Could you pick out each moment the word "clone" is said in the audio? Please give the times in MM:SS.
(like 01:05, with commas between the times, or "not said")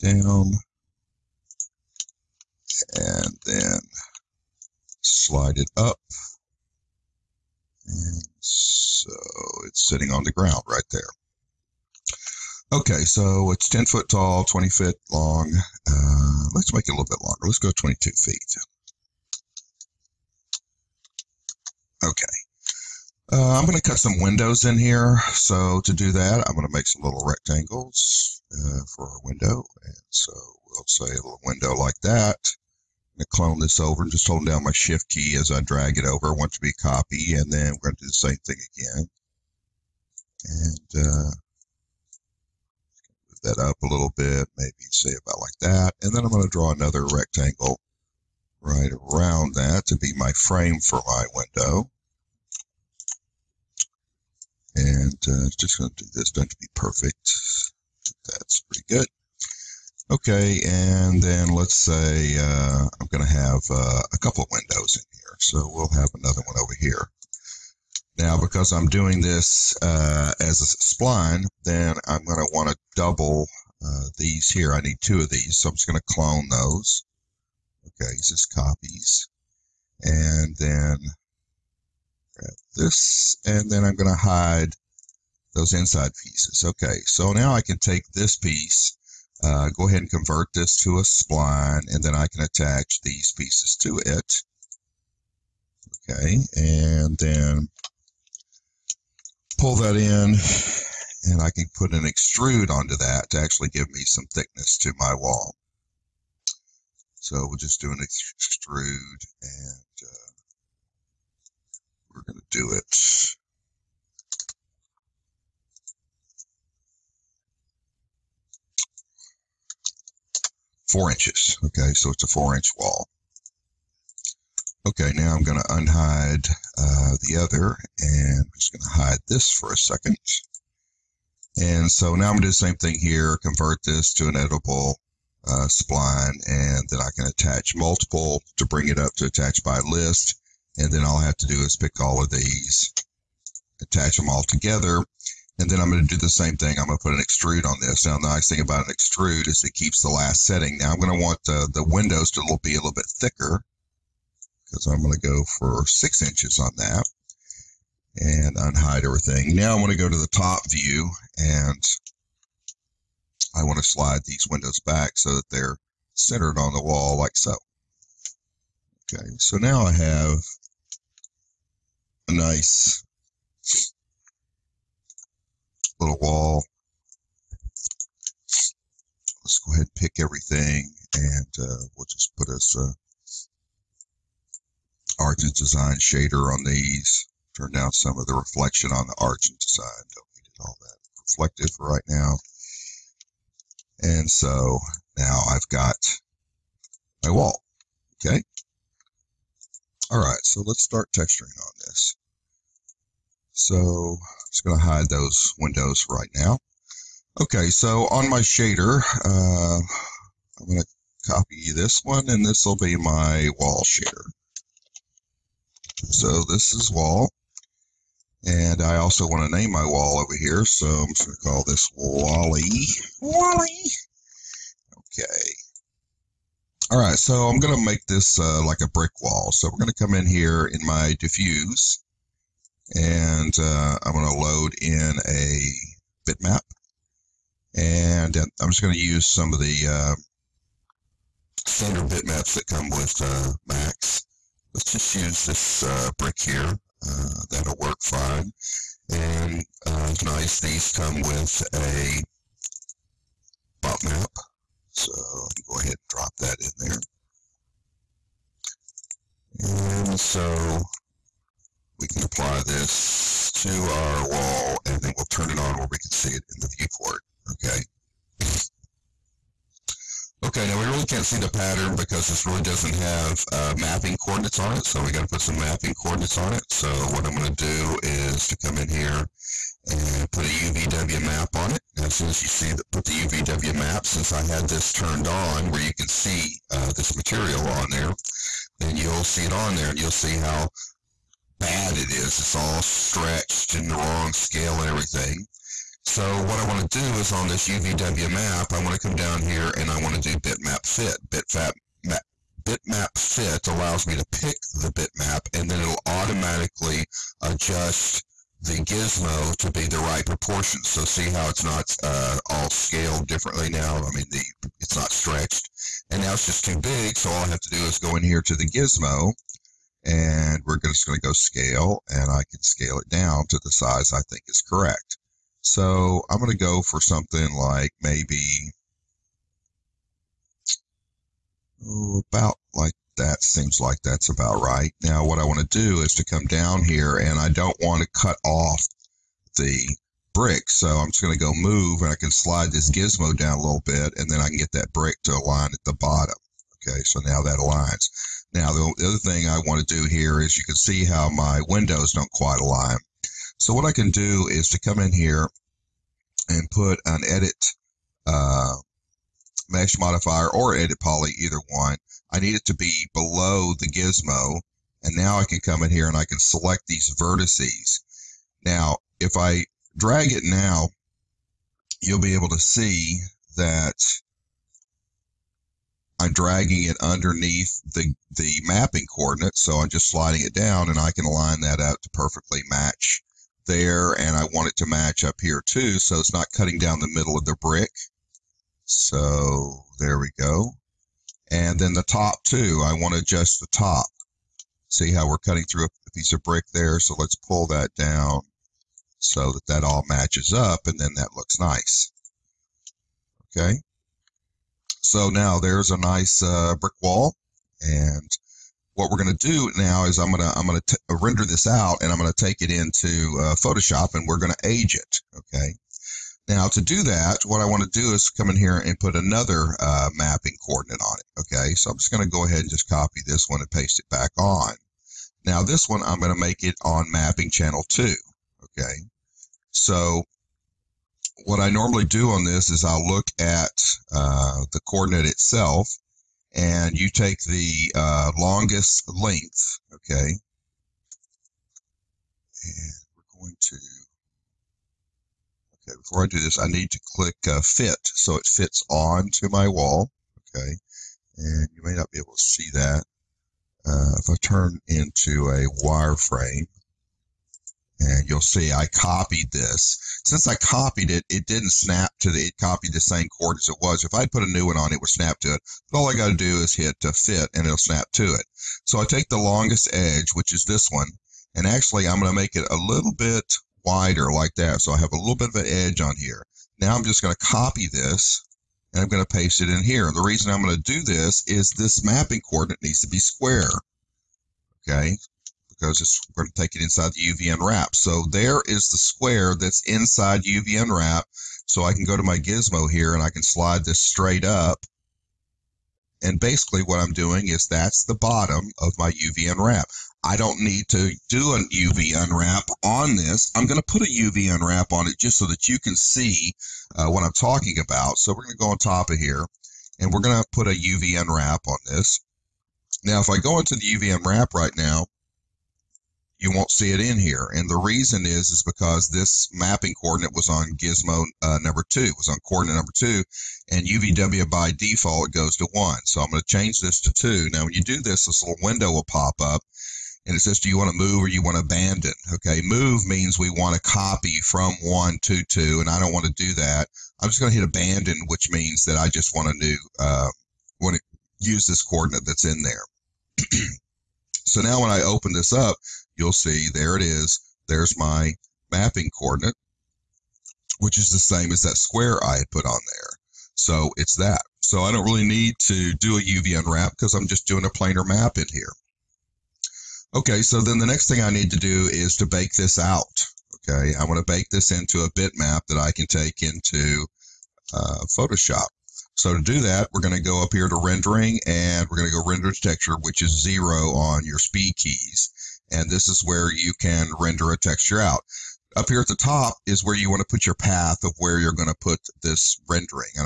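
00:33, 01:16.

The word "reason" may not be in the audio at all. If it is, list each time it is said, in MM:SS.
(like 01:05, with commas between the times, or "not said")
08:00, 08:37.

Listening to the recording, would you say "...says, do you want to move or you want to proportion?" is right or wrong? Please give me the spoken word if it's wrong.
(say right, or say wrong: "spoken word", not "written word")
wrong: "abandon", not "proportion".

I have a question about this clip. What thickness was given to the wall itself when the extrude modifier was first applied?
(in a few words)
4 inches.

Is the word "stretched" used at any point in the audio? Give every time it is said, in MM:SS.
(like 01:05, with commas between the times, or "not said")
04:52, 05:15.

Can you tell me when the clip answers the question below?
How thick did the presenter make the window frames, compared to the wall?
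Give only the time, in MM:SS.
02:35.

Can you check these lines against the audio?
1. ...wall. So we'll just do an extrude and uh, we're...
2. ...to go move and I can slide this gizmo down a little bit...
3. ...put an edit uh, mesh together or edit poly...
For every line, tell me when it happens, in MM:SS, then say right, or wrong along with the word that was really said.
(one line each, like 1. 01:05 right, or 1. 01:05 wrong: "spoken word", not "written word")
1. 01:45 right
2. 05:41 right
3. 05:56 wrong: "modifier", not "together".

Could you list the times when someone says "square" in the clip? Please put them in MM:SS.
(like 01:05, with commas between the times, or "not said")
08:03, 08:08, 09:11.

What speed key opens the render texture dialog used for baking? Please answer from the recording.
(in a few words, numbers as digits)
0.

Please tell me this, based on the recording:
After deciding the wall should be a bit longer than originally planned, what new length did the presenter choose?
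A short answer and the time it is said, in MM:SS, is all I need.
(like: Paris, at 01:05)
22 feet, at 00:17.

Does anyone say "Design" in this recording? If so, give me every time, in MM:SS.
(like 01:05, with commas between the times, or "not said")
03:05, 03:09.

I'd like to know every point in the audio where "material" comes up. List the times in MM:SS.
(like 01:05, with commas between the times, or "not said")
04:47.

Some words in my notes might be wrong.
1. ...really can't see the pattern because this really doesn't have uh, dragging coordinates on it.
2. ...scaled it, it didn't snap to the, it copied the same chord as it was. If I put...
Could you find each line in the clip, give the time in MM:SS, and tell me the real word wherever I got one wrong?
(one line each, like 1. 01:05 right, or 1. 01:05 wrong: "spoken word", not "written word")
1. 04:30 wrong: "mapping", not "dragging"
2. 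07:40 wrong: "copied", not "scaled".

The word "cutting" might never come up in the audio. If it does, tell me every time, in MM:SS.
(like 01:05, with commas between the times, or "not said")
06:26, 06:35.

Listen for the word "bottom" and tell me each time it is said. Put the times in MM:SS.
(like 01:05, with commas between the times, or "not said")
05:46, 08:18.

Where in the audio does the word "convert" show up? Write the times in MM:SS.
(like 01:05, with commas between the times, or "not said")
01:30, 02:13.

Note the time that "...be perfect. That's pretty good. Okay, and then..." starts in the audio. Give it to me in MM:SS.
00:56.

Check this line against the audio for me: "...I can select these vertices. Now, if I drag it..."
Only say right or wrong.
right.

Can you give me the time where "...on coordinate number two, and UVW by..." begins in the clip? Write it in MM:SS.
08:42.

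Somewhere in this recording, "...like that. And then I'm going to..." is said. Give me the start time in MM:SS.
00:45.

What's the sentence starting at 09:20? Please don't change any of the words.
Okay, so then the next thing I need to do is to bake this out.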